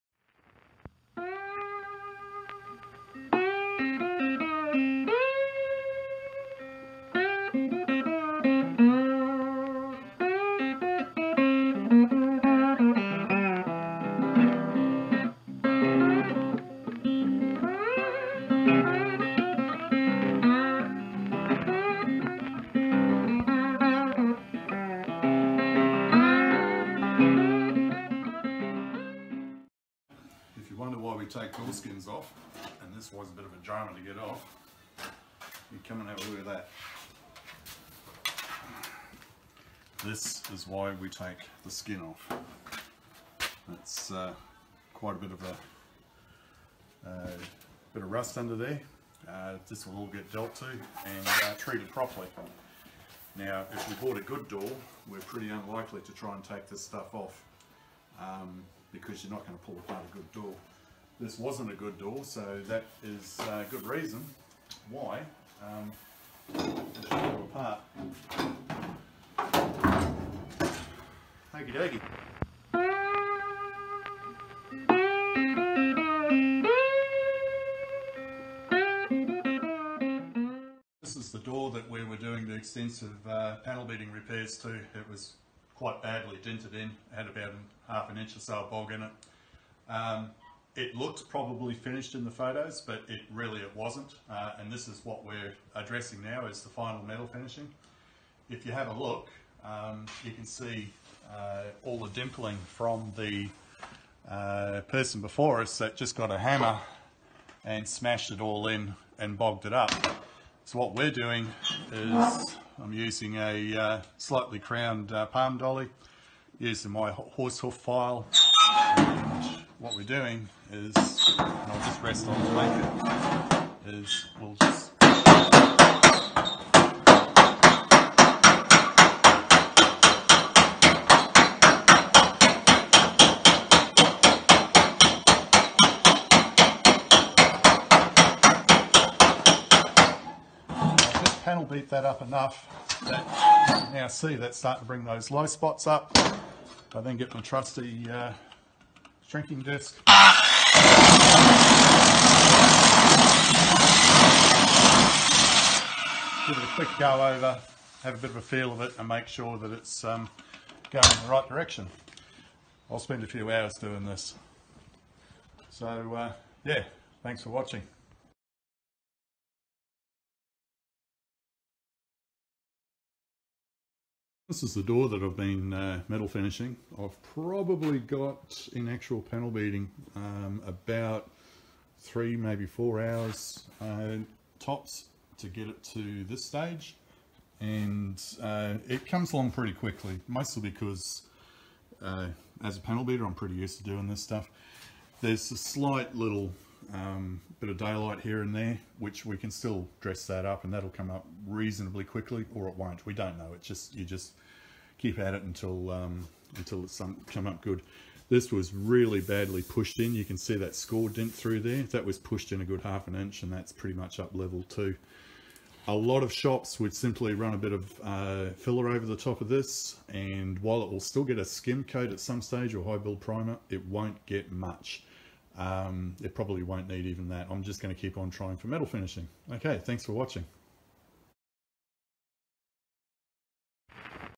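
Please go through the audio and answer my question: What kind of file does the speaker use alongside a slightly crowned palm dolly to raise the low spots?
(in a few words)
horse hoof file.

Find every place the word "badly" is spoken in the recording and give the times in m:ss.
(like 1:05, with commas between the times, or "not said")
1:26, 3:29.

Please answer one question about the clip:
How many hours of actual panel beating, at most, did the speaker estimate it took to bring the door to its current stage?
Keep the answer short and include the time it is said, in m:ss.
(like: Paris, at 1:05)
4, at 3:02.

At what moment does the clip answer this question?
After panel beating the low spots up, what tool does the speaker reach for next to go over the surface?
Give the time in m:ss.
2:29.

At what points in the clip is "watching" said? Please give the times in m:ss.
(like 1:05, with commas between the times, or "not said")
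2:47, 3:50.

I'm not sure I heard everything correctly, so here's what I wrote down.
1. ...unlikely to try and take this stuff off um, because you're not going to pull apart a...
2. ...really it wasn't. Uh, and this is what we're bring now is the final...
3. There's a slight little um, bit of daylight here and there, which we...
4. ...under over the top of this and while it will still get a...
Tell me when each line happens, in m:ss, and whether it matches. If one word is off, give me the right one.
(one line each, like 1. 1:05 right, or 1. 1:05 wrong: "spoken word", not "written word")
1. 0:55 right
2. 1:33 wrong: "addressing", not "bring"
3. 3:15 right
4. 3:38 wrong: "filler", not "under".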